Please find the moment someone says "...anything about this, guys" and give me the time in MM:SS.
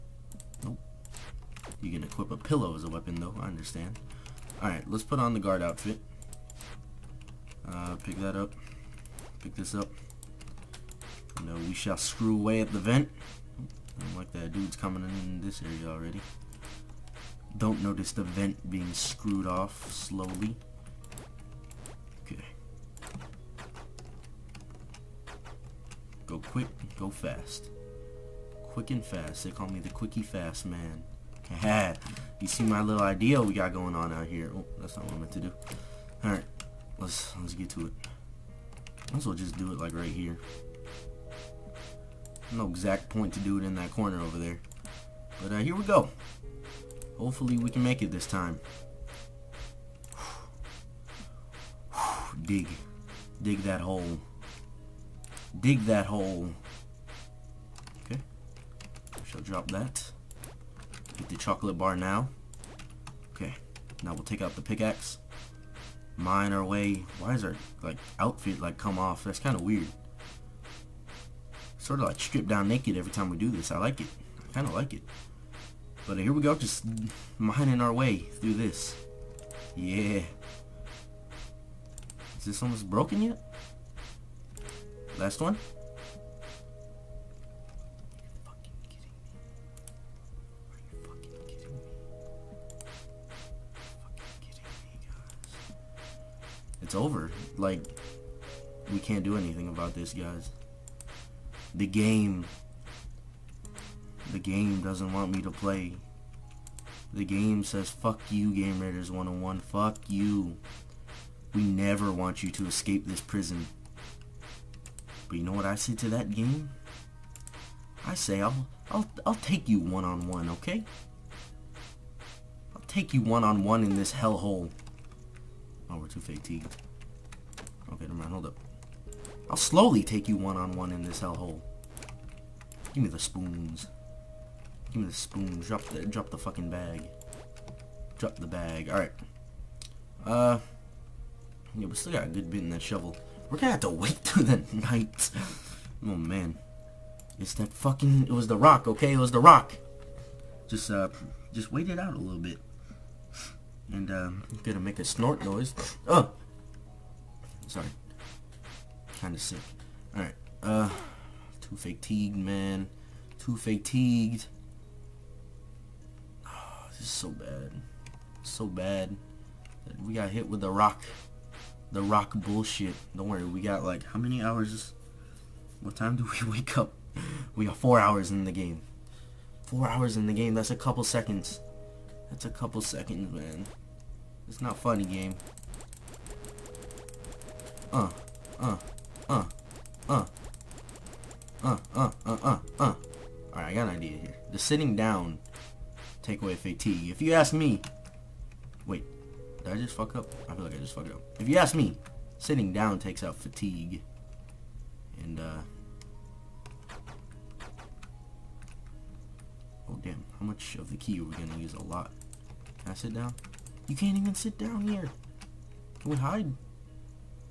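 01:39.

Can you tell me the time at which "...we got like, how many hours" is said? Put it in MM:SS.
02:53.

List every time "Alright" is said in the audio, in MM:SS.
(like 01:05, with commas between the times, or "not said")
00:04, 00:36, 02:18, 02:40, 03:13.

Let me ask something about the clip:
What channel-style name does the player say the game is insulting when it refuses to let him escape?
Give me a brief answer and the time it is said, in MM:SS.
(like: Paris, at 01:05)
Game Raiders 101, at 01:48.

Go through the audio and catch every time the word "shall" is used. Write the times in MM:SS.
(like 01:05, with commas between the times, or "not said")
00:11, 00:59.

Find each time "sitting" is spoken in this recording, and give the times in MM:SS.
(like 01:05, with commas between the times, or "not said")
03:14, 03:22.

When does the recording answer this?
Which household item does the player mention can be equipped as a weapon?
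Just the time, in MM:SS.
00:02.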